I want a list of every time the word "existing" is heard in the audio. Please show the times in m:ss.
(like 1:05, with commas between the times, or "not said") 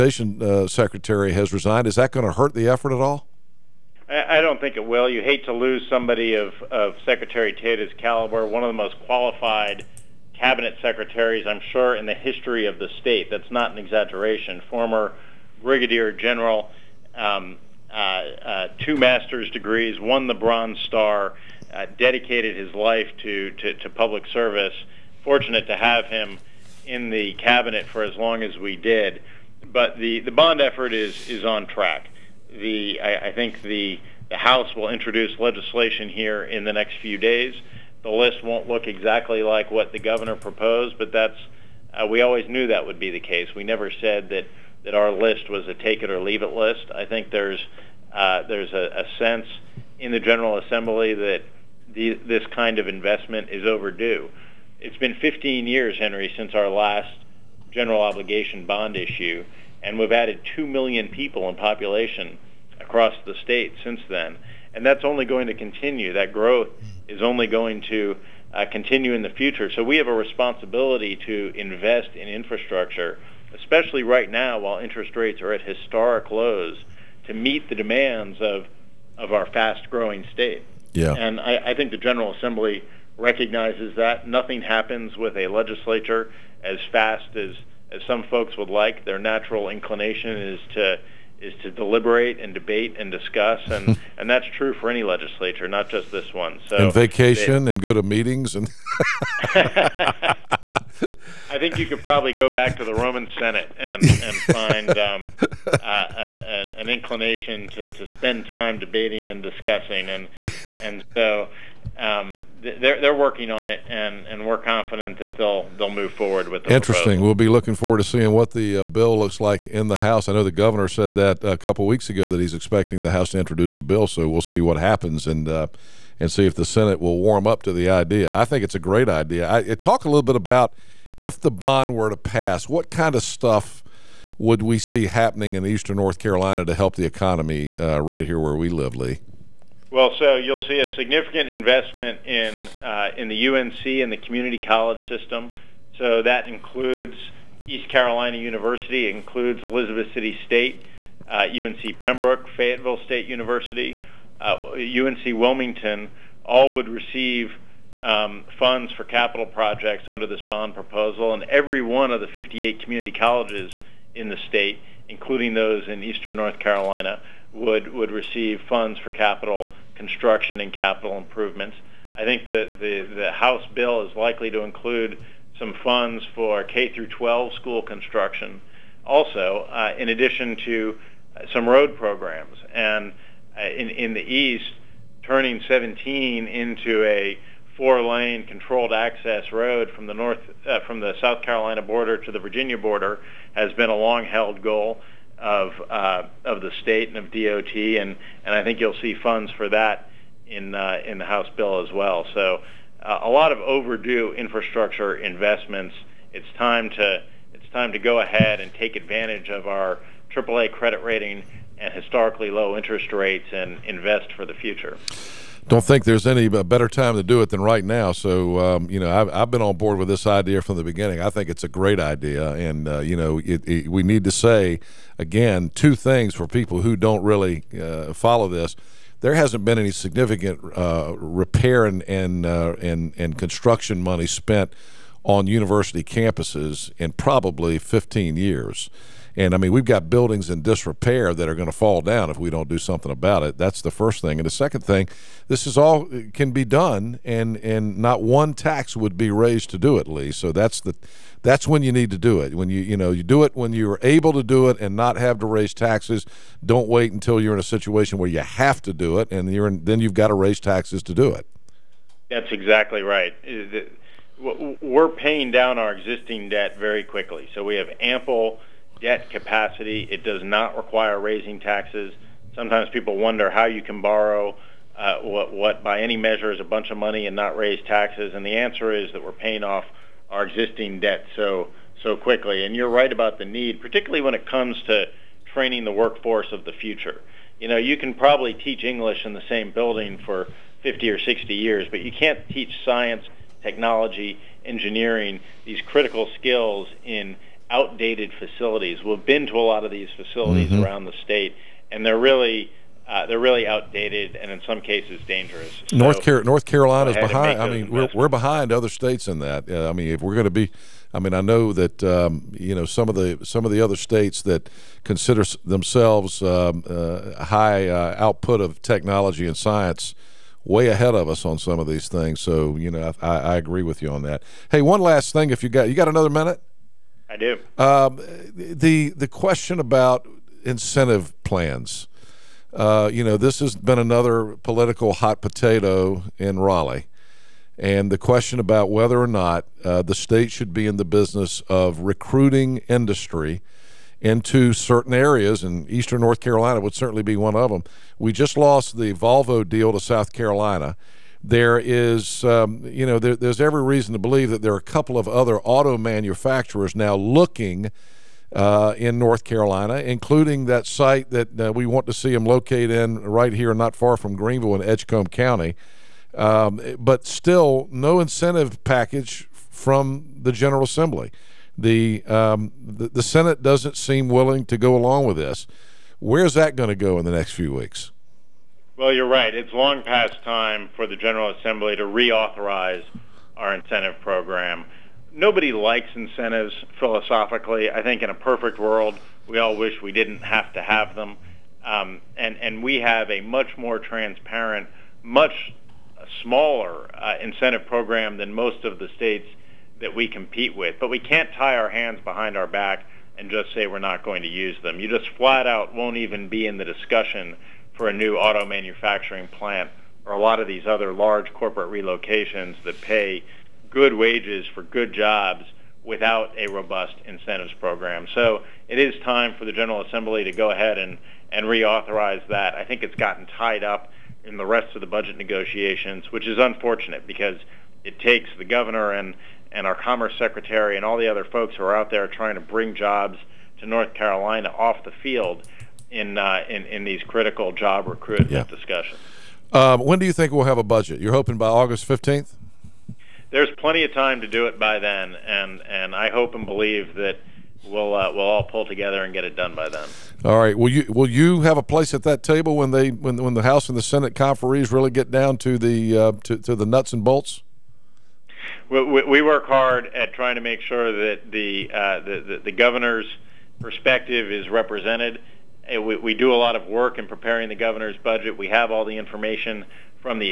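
4:25, 4:40.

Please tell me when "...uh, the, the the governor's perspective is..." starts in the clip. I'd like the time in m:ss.
7:41.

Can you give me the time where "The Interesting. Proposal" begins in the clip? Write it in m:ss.
1:56.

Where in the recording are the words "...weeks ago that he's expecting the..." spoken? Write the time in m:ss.
2:01.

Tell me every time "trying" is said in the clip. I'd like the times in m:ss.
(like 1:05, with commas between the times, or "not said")
7:12, 7:40.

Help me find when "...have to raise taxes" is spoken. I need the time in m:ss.
4:15.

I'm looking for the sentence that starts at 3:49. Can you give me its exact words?
There hasn't been any significant uh, repair and, and, uh, and, and construction money spent on university campuses in probably 15 years.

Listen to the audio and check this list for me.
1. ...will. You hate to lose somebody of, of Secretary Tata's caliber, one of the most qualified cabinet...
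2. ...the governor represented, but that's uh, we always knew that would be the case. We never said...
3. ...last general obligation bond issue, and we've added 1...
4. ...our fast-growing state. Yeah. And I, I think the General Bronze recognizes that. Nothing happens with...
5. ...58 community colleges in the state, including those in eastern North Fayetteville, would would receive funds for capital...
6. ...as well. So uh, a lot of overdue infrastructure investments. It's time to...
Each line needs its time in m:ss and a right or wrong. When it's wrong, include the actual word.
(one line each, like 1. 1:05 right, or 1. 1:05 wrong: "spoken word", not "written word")
1. 0:04 right
2. 0:39 wrong: "proposed", not "represented"
3. 0:56 wrong: "2", not "1"
4. 1:19 wrong: "Assembly", not "Bronze"
5. 2:42 wrong: "Carolina", not "Fayetteville"
6. 3:21 right.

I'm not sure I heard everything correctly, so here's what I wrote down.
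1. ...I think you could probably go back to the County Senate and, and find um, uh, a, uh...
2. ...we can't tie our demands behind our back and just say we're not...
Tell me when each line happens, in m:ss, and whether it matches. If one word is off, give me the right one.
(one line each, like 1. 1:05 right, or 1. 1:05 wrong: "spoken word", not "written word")
1. 1:41 wrong: "Roman", not "County"
2. 6:41 wrong: "hands", not "demands".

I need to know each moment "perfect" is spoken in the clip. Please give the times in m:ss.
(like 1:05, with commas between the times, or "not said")
6:28.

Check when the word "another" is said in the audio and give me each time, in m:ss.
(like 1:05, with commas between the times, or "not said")
5:26, 5:33.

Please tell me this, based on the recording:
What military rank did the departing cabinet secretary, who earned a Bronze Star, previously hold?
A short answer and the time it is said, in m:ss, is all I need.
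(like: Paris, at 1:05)
Brigadier General, at 0:15.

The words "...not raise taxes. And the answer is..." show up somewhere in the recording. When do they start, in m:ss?
4:37.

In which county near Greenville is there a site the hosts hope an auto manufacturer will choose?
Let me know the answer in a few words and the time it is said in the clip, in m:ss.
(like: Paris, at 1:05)
Edgecombe County, at 6:04.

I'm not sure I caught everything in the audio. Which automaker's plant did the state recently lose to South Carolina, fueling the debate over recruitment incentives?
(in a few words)
Volvo.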